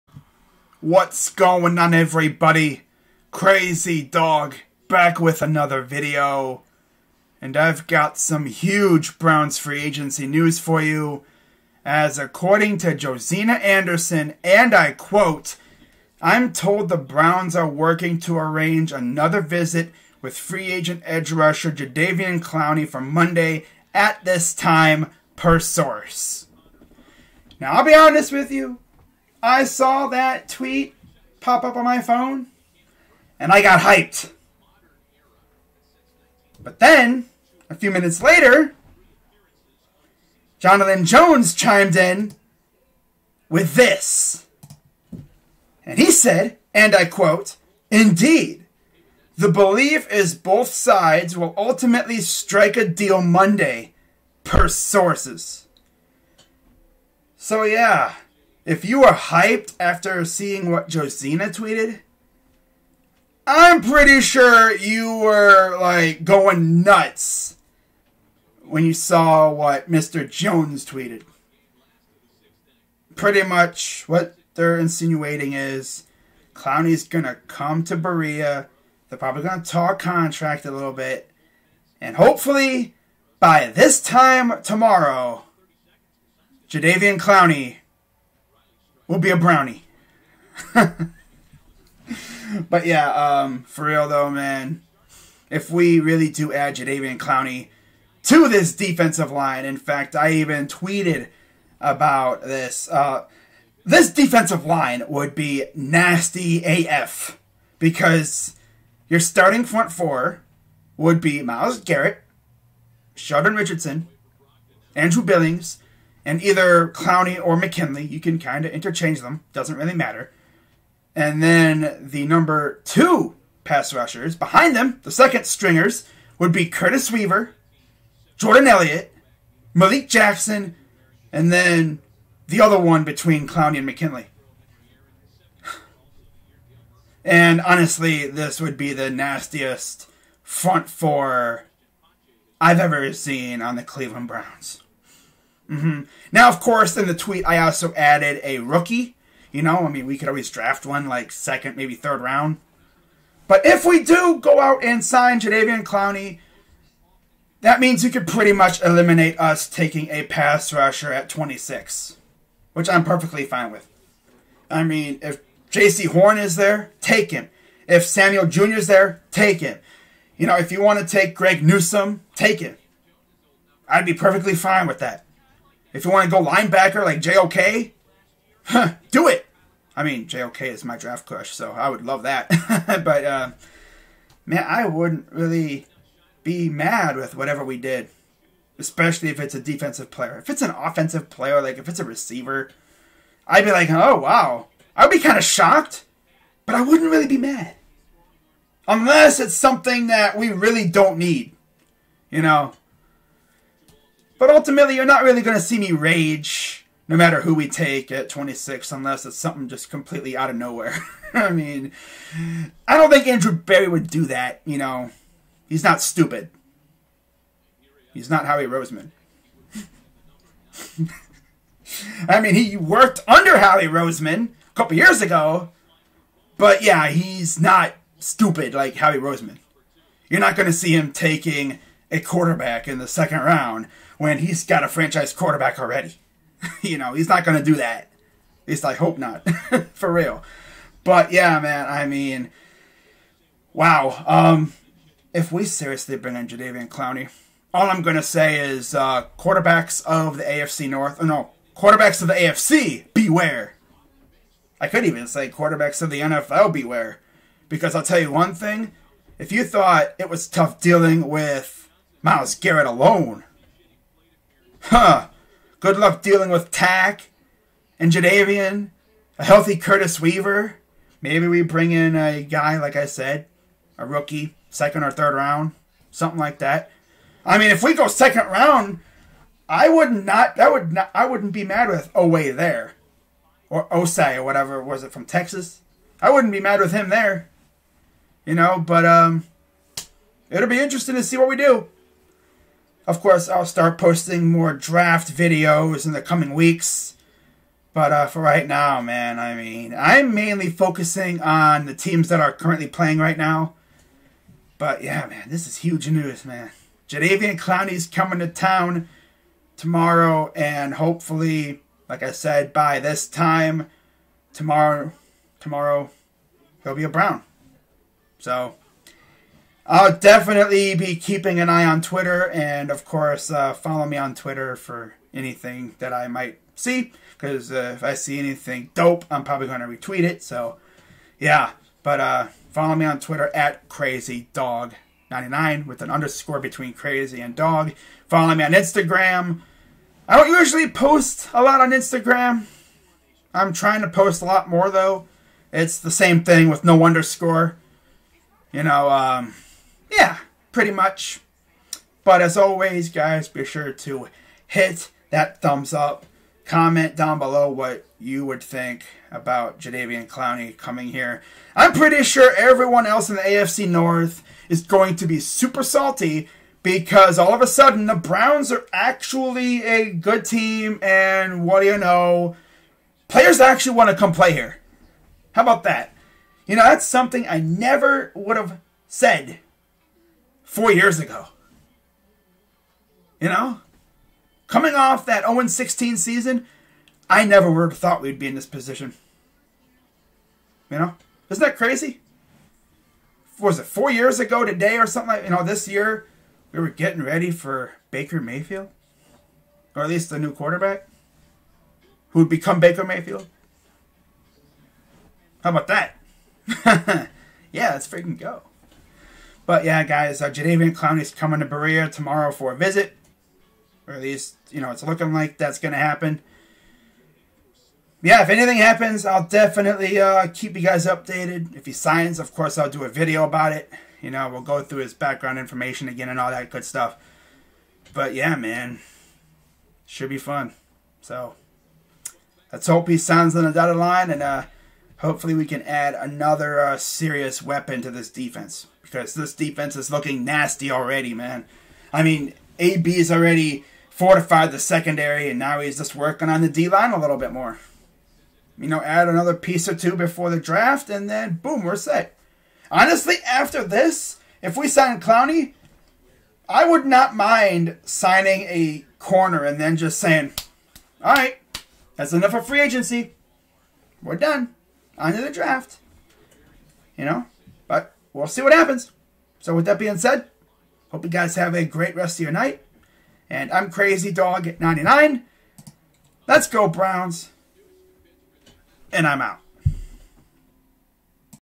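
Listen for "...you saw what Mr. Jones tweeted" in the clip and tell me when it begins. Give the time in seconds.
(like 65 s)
68 s.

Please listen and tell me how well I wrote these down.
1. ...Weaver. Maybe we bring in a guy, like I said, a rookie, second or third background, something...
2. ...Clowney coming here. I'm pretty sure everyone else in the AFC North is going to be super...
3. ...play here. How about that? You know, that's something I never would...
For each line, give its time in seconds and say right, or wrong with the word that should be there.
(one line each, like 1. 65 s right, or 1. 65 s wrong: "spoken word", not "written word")
1. 270 s wrong: "round", not "background"
2. 360 s right
3. 374 s right.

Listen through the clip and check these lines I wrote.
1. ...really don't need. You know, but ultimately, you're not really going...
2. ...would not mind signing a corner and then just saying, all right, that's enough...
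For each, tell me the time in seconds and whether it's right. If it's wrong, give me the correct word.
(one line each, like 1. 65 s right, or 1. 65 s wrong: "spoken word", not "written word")
1. 200 s right
2. 456 s right.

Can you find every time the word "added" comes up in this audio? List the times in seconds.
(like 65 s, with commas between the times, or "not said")
147 s.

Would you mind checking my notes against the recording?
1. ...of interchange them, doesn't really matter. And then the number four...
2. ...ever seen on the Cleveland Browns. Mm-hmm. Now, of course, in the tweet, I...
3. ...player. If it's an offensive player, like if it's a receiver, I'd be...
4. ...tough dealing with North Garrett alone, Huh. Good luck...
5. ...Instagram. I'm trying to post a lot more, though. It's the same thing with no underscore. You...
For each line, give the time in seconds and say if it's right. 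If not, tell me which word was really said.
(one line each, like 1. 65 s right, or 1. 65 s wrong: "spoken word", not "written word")
1. 118 s wrong: "two", not "four"
2. 142 s right
3. 190 s right
4. 260 s wrong: "Myles", not "North"
5. 341 s right.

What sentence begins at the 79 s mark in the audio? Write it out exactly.
They're probably gonna talk contract a little bit, and hopefully by this time tomorrow, Jadeveon Clowney will be a brownie.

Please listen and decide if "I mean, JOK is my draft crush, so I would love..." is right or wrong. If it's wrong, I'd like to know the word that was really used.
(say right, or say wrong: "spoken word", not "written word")
right.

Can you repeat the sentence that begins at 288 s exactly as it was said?
But um, it'll be interesting to see what we do.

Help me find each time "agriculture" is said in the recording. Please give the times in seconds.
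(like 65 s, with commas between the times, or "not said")
not said.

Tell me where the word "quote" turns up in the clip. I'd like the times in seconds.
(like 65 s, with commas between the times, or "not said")
14 s, 47 s.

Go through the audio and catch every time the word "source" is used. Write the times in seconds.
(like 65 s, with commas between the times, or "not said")
25 s, 54 s.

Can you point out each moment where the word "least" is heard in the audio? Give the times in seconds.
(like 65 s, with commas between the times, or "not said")
238 s, 400 s, 414 s.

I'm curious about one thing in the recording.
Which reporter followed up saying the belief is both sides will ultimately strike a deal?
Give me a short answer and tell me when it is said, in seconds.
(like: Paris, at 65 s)
Jonathan Jones, at 40 s.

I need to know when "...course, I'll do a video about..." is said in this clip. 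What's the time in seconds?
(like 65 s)
422 s.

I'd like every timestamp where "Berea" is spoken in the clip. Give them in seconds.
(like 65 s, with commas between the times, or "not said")
77 s, 411 s.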